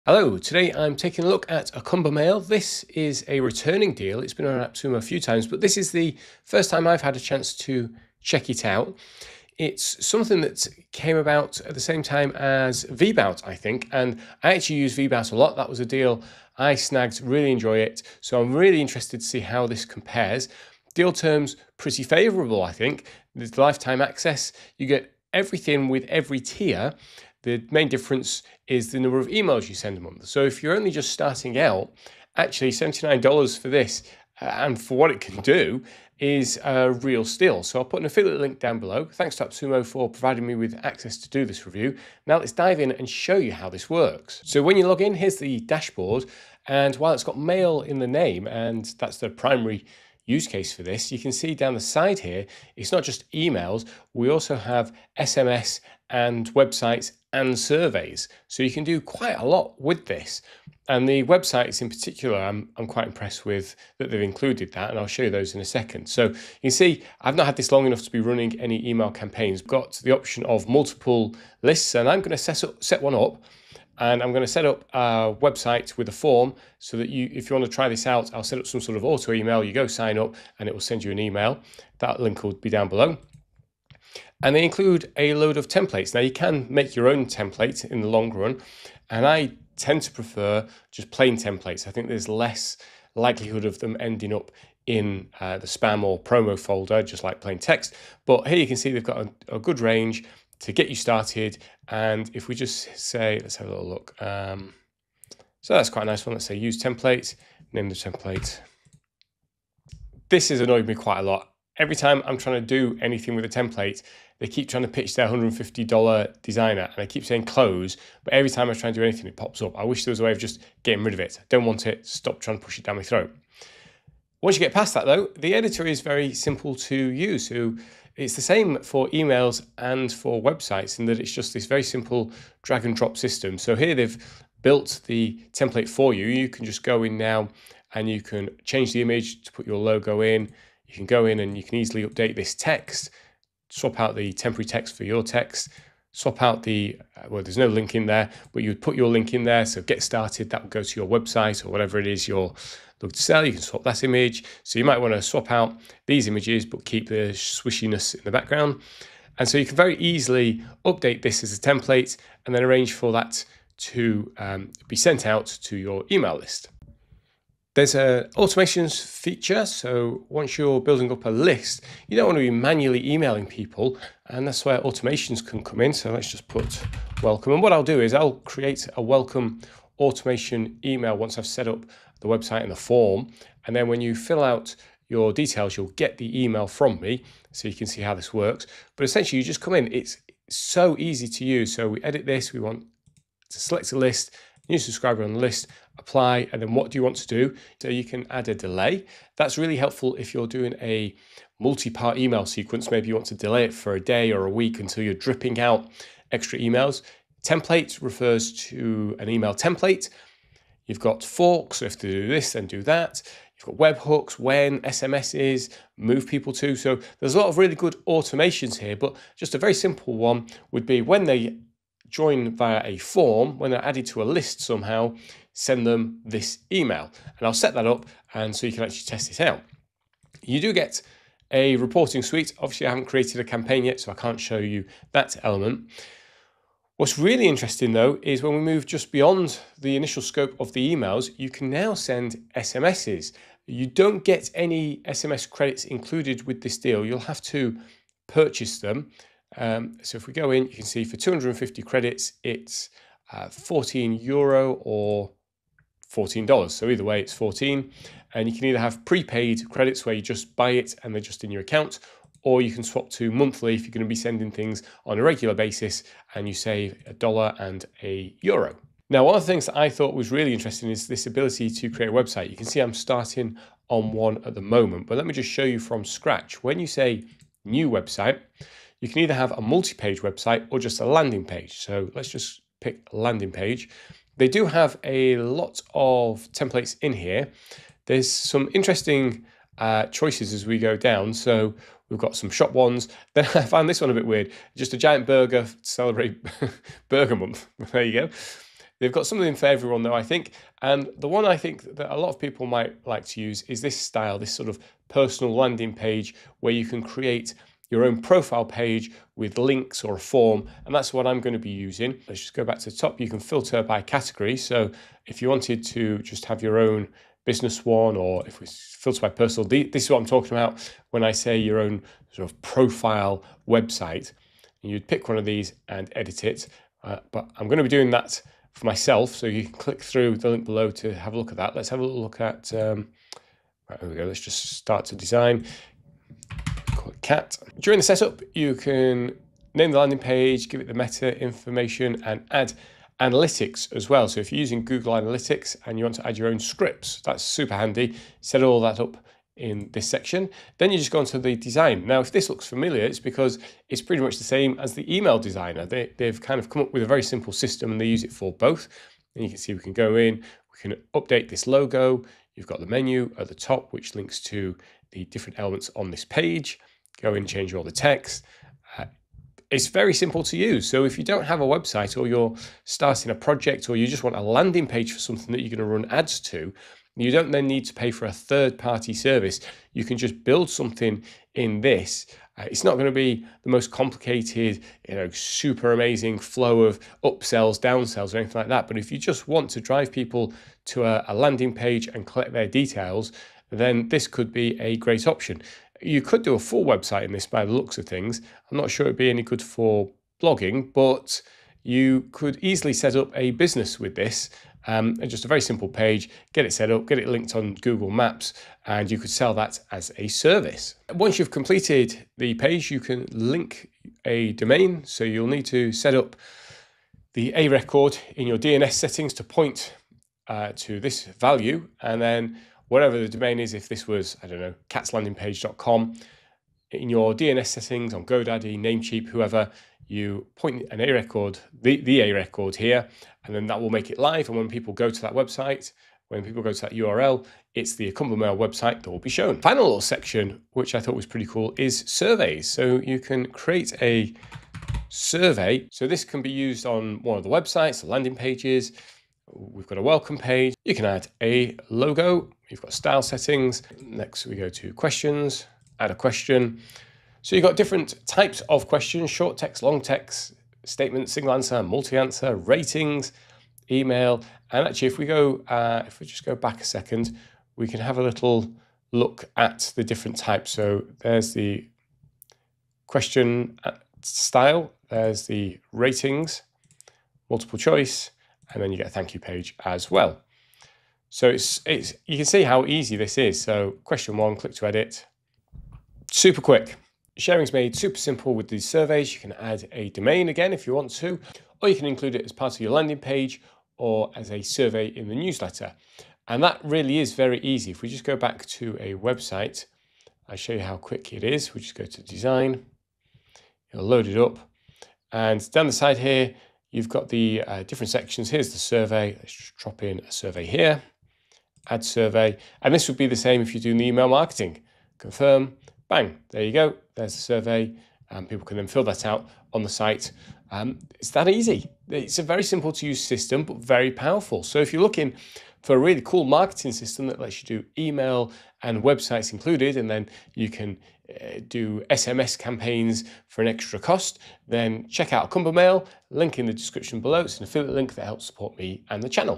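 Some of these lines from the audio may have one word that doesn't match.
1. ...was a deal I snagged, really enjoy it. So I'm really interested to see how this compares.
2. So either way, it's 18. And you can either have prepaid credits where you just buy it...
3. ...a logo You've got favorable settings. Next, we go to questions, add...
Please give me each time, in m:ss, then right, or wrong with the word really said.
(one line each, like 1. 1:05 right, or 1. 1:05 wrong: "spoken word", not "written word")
1. 0:15 right
2. 4:16 wrong: "14", not "18"
3. 7:31 wrong: "style", not "favorable".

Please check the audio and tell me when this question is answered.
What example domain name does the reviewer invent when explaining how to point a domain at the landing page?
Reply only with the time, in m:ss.
7:04.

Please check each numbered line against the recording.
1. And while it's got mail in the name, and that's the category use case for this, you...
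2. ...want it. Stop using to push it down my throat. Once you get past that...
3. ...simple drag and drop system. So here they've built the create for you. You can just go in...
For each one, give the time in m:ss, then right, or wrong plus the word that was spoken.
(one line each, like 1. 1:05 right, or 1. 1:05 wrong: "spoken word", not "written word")
1. 0:46 wrong: "primary", not "category"
2. 2:01 wrong: "trying", not "using"
3. 2:11 wrong: "template", not "create".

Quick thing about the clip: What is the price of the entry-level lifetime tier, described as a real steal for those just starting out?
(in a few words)
$79.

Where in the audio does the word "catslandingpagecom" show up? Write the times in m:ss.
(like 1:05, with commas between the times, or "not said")
7:04.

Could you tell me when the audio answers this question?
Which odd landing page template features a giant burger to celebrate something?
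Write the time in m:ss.
4:57.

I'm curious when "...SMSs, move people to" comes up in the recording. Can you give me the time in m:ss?
3:34.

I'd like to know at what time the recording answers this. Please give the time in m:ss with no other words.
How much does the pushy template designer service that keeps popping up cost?
1:55.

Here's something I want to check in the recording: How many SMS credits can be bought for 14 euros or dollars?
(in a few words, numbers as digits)
250.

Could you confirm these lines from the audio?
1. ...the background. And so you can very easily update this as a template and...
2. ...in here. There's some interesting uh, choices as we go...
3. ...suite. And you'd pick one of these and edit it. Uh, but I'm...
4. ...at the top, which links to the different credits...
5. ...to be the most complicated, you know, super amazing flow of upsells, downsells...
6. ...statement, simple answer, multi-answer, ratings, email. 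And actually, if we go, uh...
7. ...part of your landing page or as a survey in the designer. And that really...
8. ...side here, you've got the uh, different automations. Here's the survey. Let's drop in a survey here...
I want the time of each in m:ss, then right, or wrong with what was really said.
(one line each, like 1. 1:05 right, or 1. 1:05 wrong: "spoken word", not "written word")
1. 2:38 right
2. 4:47 right
3. 5:23 wrong: "website", not "suite"
4. 6:03 wrong: "elements", not "credits"
5. 6:23 right
6. 7:40 wrong: "single", not "simple"
7. 8:12 wrong: "newsletter", not "designer"
8. 8:25 wrong: "sections", not "automations".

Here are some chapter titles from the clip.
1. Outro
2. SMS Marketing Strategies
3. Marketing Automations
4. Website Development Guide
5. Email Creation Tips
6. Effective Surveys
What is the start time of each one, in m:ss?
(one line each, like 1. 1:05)
1. 8:41
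2. 3:50
3. 2:47
4. 4:29
5. 0:42
6. 7:20.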